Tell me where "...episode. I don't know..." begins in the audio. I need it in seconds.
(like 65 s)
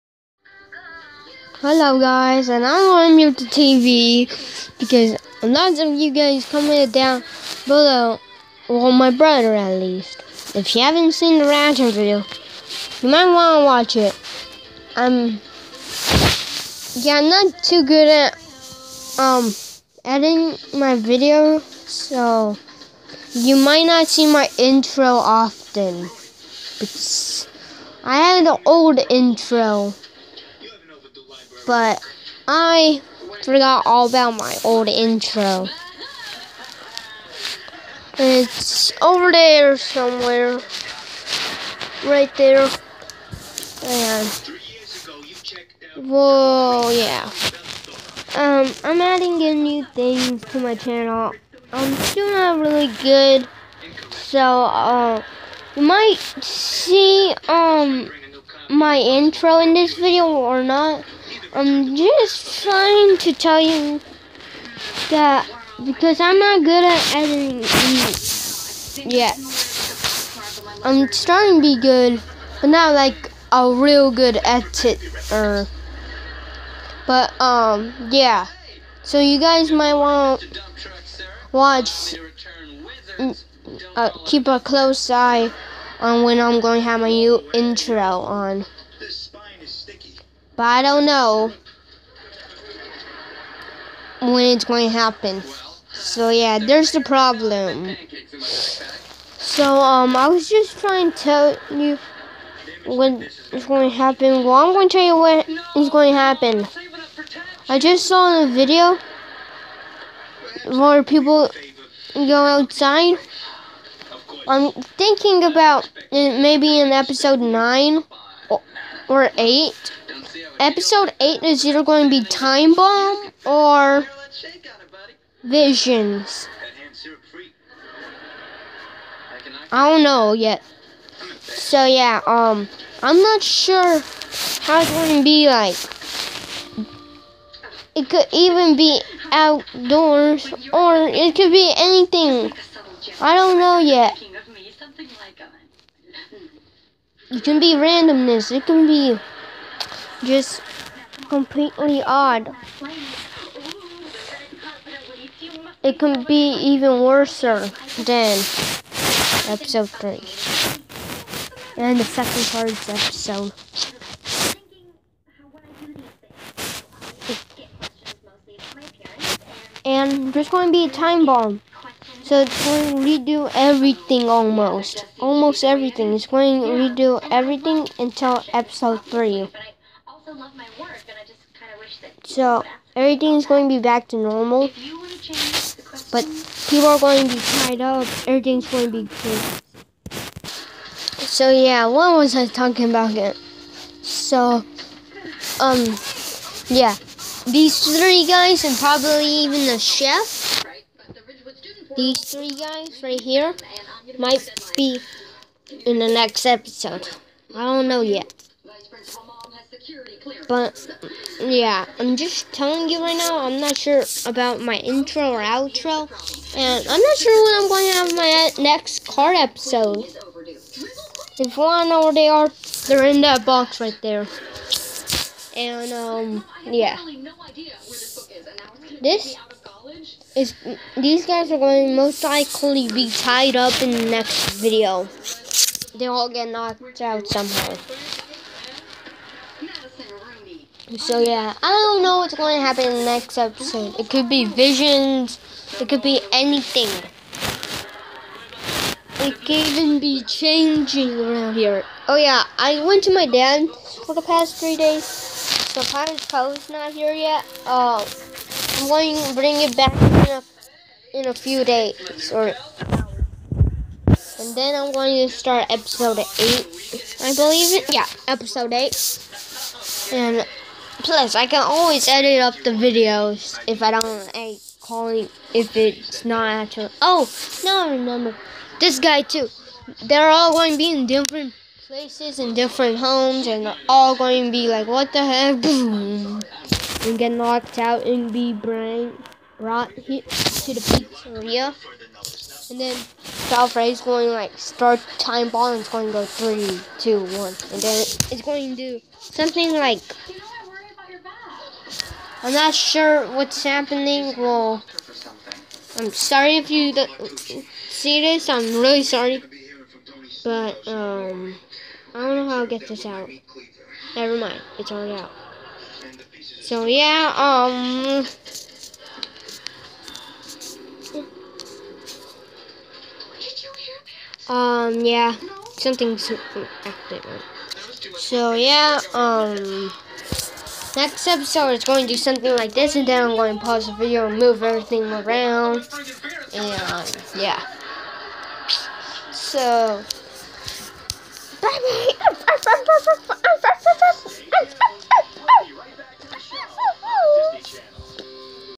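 206 s.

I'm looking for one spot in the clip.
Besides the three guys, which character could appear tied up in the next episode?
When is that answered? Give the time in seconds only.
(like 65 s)
199 s.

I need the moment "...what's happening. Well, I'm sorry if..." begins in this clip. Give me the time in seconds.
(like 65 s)
303 s.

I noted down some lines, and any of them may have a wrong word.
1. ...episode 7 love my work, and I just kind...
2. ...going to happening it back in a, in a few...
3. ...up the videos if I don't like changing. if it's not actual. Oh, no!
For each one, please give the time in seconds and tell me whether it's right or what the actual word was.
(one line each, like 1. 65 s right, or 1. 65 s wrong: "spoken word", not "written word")
1. 178 s wrong: "3", not "7"
2. 258 s wrong: "bring", not "happening"
3. 272 s wrong: "calling", not "changing".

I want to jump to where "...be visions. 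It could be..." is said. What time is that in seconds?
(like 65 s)
244 s.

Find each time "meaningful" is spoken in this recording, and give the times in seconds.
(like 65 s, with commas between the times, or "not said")
not said.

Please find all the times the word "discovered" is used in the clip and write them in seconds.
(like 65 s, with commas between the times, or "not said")
not said.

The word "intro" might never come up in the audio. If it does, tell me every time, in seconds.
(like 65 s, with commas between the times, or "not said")
24 s, 29 s, 34 s, 58 s, 87 s, 214 s.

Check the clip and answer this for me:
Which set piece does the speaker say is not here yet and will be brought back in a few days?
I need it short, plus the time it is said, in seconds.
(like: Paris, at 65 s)
Pirate's Cove, at 255 s.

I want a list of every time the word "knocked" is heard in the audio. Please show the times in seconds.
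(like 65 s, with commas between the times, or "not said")
236 s, 287 s.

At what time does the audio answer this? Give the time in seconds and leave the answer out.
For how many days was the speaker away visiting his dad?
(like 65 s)
254 s.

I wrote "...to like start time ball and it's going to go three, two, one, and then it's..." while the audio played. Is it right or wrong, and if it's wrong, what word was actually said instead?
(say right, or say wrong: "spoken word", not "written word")
right.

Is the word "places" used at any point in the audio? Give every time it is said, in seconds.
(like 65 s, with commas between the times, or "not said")
281 s.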